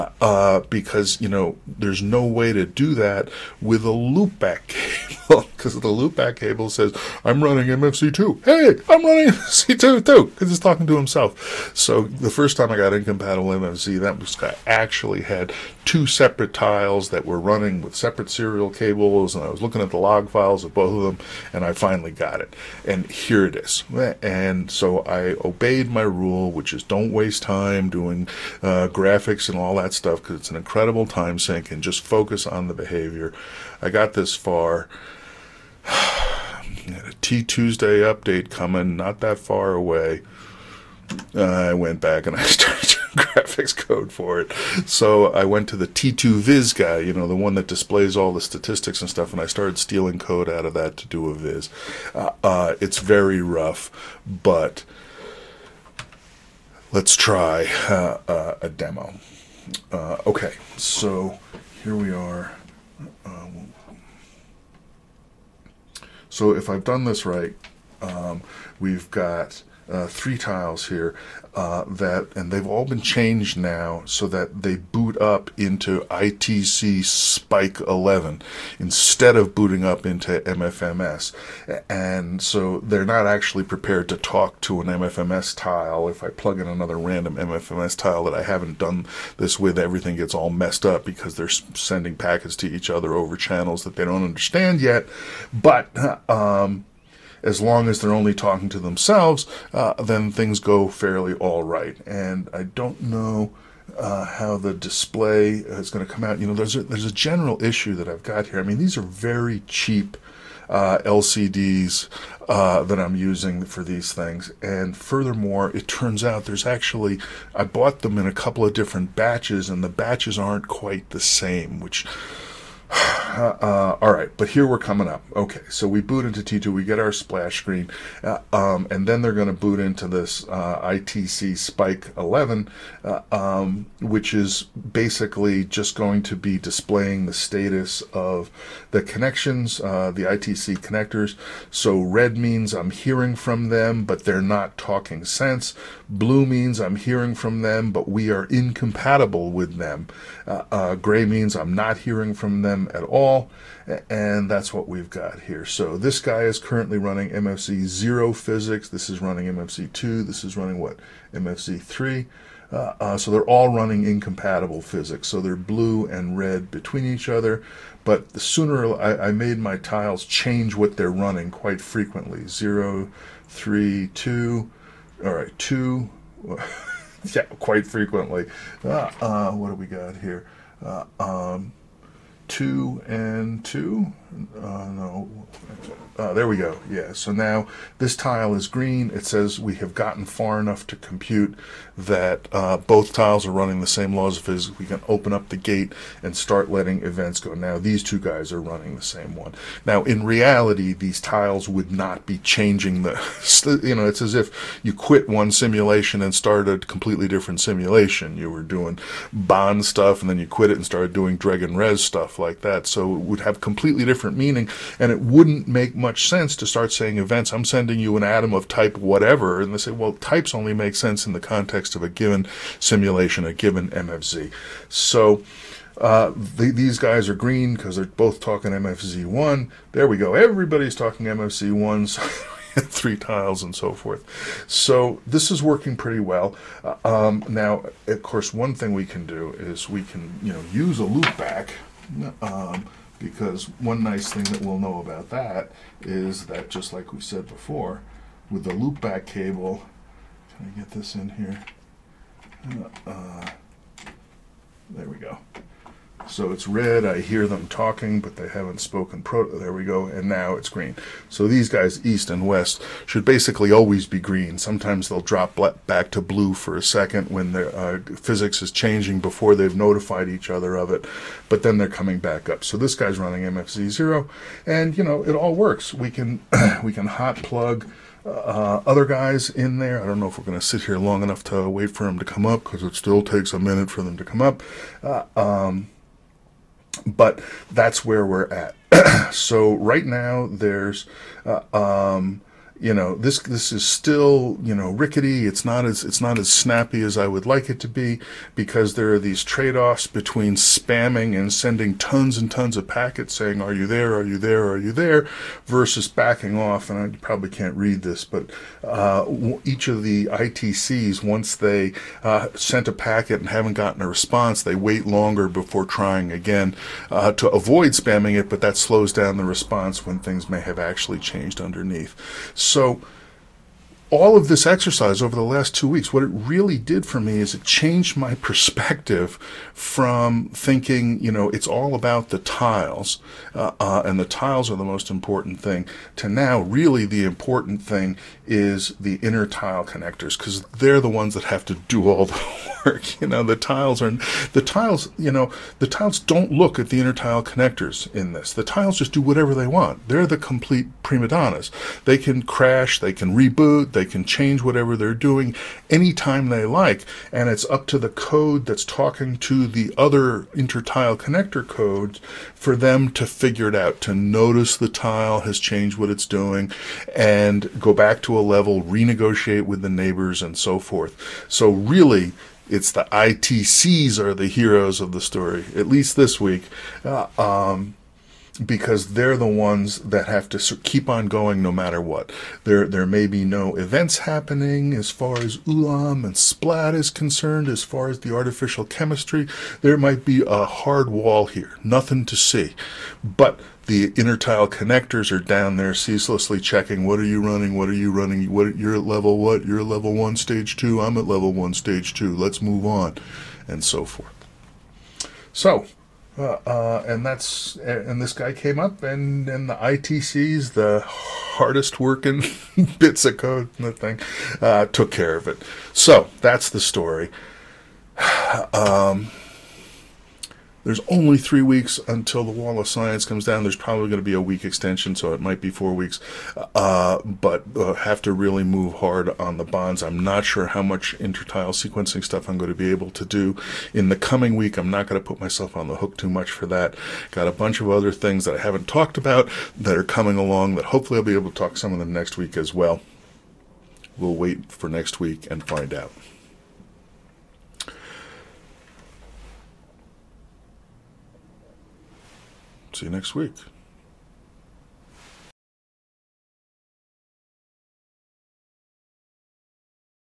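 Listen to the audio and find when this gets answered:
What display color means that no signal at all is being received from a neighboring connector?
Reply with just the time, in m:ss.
2:30.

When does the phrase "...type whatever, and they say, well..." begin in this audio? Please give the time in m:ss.
3:38.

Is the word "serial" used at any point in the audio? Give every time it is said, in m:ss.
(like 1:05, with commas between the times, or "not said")
0:18.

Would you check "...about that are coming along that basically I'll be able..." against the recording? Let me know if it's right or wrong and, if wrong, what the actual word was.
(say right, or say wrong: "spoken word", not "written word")
wrong: "hopefully", not "basically".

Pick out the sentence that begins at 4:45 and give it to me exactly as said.
Uh, um, but that's where we're at.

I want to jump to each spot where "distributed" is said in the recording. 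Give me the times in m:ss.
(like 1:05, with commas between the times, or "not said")
not said.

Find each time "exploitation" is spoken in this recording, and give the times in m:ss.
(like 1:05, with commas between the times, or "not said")
not said.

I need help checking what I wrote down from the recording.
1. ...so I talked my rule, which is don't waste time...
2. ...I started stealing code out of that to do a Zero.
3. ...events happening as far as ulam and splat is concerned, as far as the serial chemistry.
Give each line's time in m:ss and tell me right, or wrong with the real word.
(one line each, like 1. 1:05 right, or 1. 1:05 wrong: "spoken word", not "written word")
1. 0:24 wrong: "obeyed", not "talked"
2. 0:49 wrong: "Viz", not "Zero"
3. 6:23 wrong: "artificial", not "serial".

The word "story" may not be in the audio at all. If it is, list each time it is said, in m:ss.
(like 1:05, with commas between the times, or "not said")
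6:15, 6:56.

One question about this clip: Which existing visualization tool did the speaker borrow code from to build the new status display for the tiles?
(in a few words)
T2 Viz.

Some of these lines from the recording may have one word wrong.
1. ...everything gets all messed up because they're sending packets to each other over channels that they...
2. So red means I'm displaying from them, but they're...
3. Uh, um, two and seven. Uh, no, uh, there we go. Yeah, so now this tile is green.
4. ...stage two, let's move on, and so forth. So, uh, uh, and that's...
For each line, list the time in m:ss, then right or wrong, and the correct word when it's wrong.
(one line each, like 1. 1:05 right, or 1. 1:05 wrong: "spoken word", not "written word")
1. 1:29 right
2. 2:21 wrong: "hearing", not "displaying"
3. 3:00 wrong: "two", not "seven"
4. 6:41 right.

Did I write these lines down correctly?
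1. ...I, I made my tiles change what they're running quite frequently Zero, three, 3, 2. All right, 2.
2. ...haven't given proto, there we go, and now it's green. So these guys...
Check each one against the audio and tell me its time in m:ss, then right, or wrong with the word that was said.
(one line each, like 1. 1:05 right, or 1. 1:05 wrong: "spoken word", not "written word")
1. 2:48 right
2. 4:18 wrong: "spoken", not "given".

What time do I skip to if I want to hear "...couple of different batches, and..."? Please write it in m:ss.
1:58.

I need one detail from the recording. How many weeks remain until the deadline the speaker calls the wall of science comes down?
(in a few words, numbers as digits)
3.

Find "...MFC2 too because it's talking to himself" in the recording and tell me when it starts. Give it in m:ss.
0:09.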